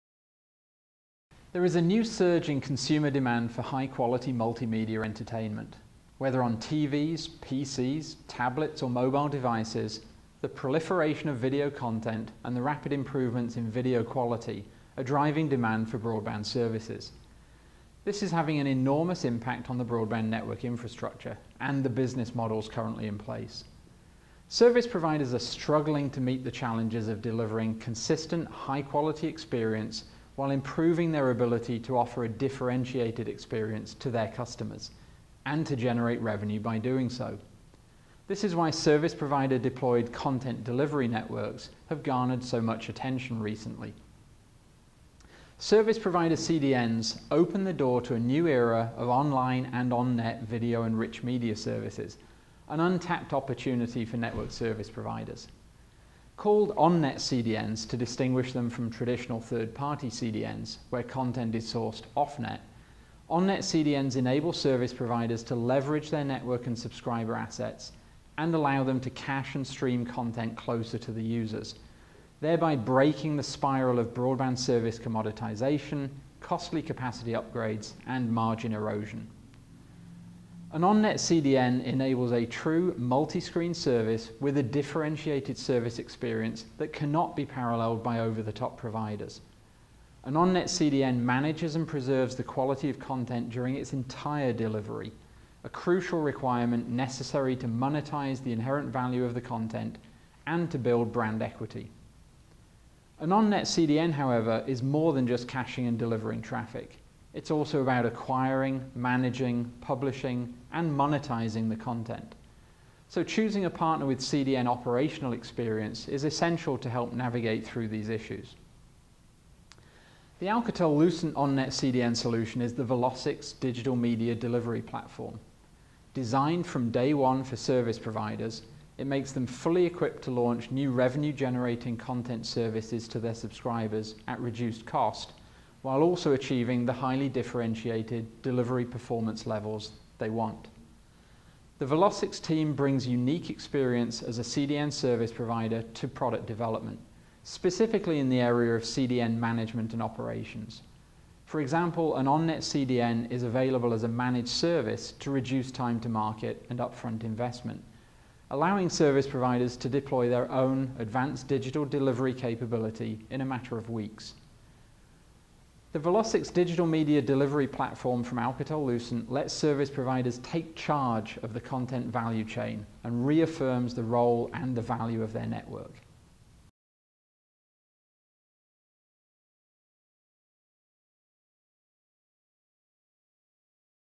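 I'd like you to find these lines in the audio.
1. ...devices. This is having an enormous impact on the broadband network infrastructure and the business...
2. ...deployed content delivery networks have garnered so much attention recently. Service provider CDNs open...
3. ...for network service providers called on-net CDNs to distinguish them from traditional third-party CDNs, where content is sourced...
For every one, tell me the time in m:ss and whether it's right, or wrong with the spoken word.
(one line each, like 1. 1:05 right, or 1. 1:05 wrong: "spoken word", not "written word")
1. 0:16 wrong: "services", not "devices"
2. 0:39 right
3. 0:54 right.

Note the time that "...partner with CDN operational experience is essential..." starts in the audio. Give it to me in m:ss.
1:53.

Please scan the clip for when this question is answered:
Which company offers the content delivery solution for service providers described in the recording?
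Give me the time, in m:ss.
2:00.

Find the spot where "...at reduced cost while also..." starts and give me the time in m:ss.
2:14.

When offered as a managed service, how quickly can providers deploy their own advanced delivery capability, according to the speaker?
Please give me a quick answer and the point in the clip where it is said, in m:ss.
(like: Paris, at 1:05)
a matter of weeks, at 2:43.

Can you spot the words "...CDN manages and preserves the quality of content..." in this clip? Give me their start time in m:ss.
1:30.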